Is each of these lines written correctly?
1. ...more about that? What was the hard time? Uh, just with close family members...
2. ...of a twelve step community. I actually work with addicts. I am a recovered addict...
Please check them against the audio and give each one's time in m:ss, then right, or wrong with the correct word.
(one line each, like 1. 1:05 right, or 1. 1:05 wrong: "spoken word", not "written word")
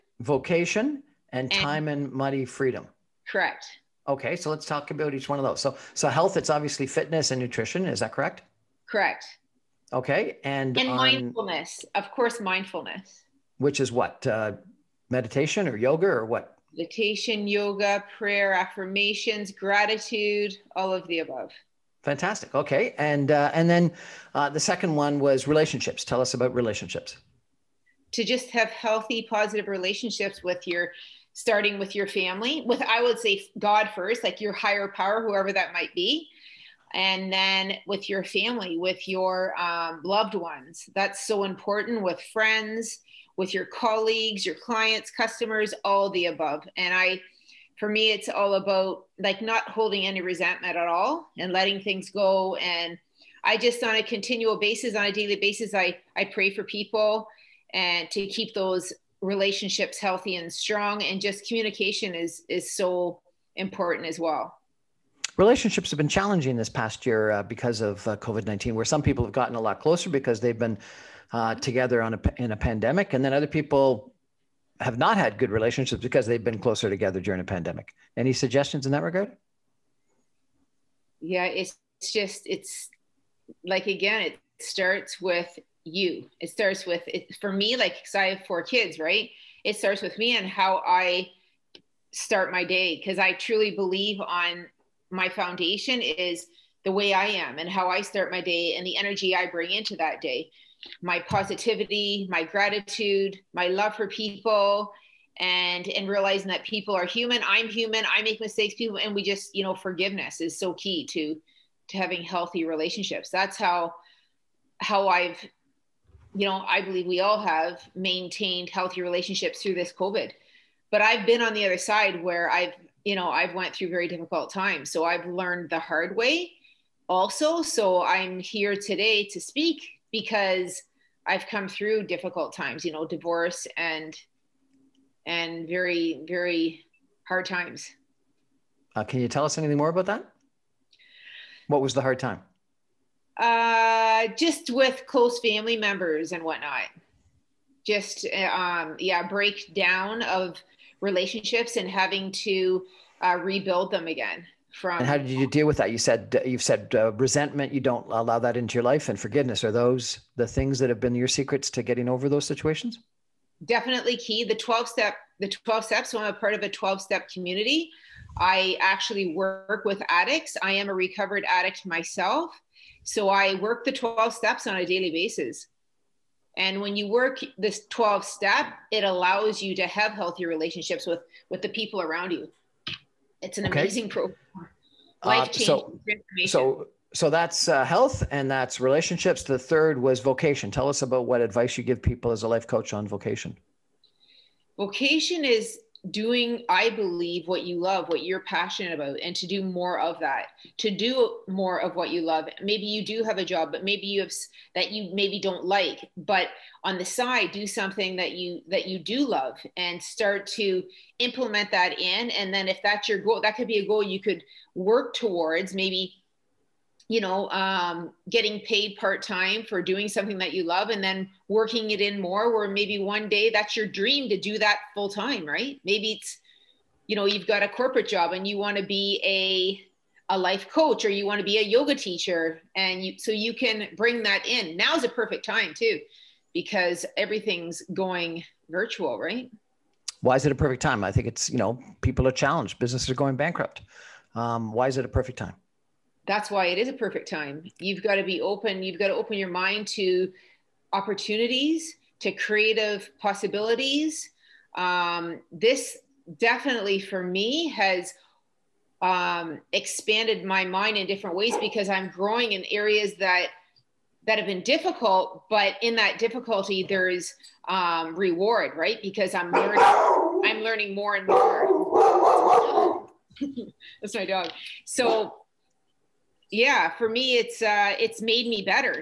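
1. 2:19 right
2. 2:46 right.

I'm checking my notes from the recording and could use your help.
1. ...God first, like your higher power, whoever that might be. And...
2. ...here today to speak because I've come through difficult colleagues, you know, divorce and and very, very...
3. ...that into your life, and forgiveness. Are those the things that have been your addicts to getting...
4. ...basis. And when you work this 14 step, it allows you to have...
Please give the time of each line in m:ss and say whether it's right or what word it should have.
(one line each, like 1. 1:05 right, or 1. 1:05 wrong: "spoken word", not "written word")
1. 0:33 right
2. 2:08 wrong: "times", not "colleagues"
3. 2:38 wrong: "secrets", not "addicts"
4. 2:55 wrong: "12", not "14".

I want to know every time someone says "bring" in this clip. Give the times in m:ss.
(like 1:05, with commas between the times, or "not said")
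1:39, 3:53.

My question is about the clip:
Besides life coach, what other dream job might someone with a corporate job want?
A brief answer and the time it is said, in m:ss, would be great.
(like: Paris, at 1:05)
Yoga teacher, at 3:51.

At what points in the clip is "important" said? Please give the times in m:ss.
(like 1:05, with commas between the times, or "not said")
0:41, 1:03.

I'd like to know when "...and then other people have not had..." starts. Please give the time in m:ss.
1:13.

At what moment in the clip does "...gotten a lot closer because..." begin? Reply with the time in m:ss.
1:09.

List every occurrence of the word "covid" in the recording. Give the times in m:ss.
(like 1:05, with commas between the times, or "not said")
1:08, 1:59.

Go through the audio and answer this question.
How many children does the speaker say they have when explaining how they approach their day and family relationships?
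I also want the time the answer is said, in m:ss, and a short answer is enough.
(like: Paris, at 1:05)
4, at 1:28.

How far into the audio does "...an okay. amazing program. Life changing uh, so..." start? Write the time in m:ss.
3:03.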